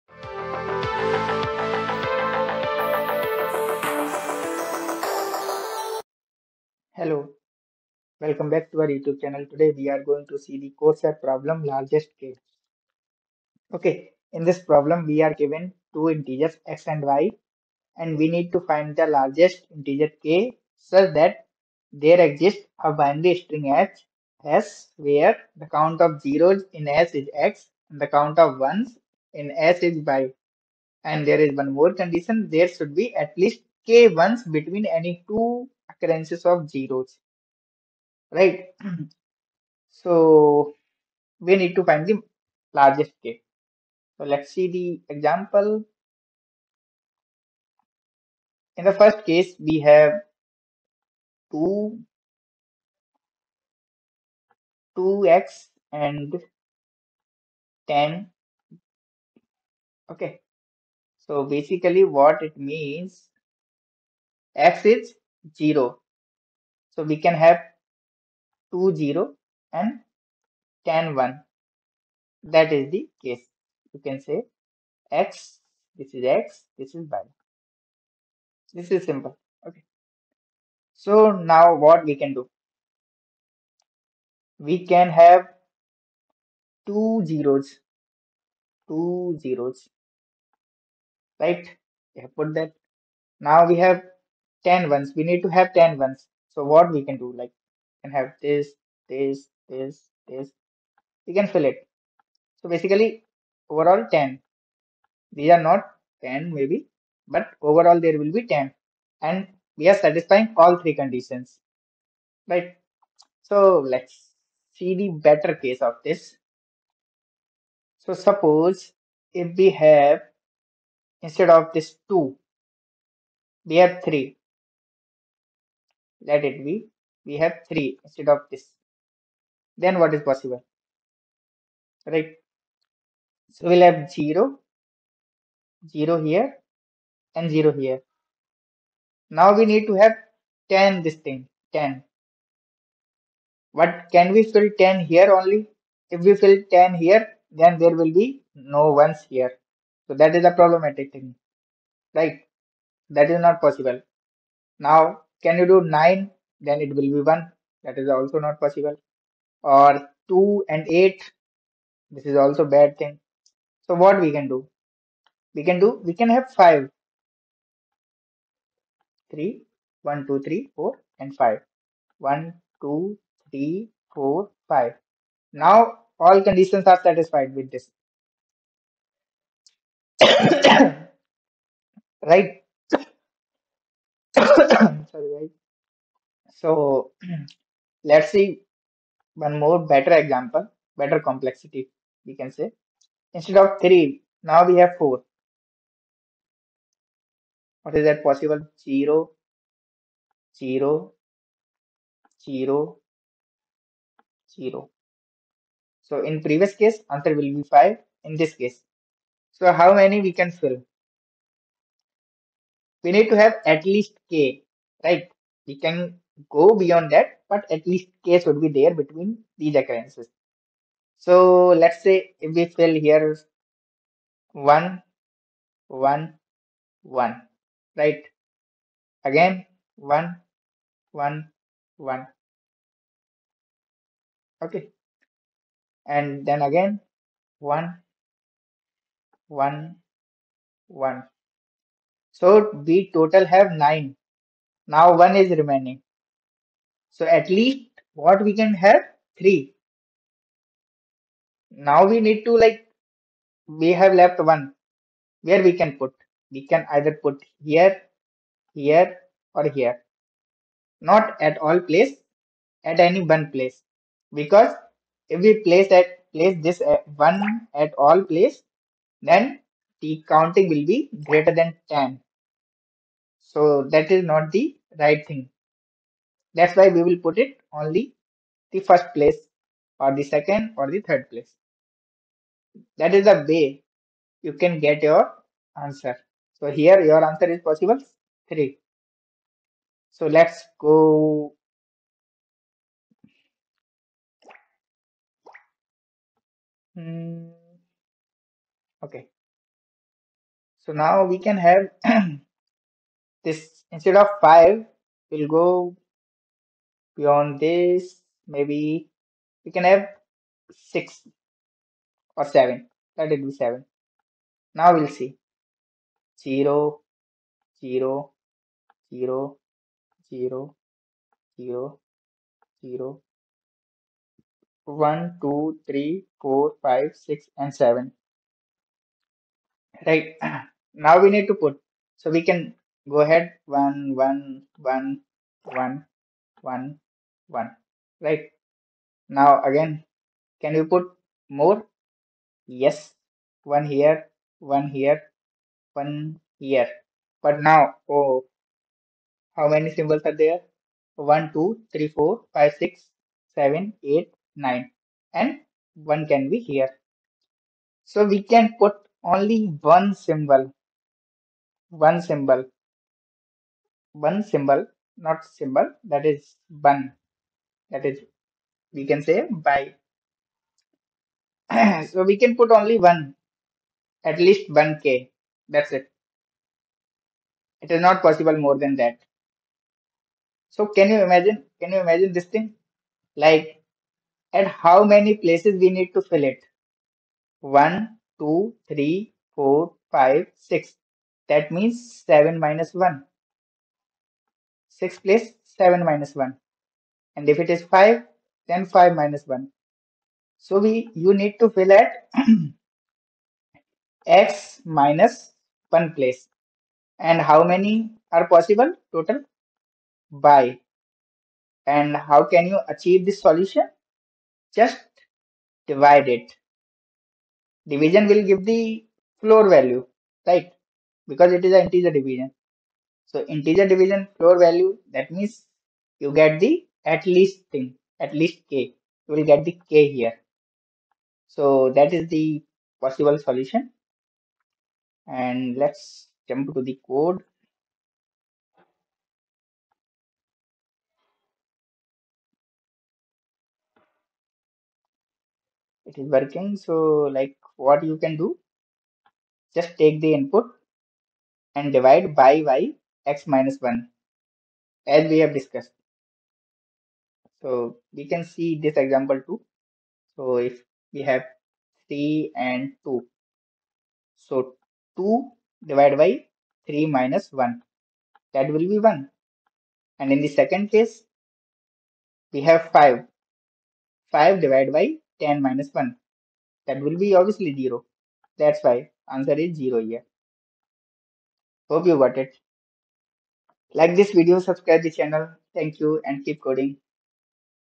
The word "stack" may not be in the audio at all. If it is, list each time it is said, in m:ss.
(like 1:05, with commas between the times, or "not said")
not said.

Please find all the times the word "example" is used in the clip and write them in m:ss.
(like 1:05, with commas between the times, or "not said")
0:45, 3:10, 7:38.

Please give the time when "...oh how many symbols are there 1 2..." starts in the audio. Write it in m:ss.
5:48.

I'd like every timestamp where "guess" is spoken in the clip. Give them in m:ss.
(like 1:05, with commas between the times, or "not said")
not said.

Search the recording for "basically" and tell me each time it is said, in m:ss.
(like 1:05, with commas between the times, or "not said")
1:01, 1:42.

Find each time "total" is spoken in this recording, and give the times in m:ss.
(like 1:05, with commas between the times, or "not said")
4:03, 6:49.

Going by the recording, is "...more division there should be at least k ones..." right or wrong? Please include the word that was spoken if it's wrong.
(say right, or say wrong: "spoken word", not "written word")
wrong: "condition", not "division".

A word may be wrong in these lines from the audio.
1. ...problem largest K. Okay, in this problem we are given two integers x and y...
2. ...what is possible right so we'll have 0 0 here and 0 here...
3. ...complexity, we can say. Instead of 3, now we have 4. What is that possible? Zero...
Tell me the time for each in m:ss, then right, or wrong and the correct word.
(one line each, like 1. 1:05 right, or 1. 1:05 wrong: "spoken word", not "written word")
1. 0:11 right
2. 2:10 right
3. 3:11 right.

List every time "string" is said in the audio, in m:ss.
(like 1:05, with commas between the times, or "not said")
0:23.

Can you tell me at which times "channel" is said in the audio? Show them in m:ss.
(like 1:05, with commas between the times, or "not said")
0:09, 8:05.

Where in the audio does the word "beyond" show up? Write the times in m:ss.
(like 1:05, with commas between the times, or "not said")
3:36, 5:07.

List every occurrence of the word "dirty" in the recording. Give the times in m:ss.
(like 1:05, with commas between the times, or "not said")
not said.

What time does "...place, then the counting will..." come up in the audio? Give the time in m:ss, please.
4:28.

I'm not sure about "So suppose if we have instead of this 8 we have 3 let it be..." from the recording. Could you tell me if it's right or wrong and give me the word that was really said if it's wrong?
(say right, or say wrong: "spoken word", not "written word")
wrong: "2", not "8".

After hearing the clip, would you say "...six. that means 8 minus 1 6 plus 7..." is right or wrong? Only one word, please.
wrong.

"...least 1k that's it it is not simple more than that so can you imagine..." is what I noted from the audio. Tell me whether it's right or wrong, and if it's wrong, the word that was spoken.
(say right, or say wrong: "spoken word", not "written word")
wrong: "possible", not "simple".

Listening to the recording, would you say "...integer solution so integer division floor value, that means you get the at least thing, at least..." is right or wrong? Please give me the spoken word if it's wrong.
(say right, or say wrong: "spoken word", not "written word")
wrong: "division", not "solution".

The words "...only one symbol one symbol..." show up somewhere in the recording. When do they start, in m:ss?
5:59.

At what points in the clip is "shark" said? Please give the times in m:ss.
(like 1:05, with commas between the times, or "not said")
not said.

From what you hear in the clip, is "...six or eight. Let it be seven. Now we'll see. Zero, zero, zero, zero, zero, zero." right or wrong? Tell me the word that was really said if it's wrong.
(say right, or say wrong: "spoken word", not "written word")
wrong: "seven", not "eight".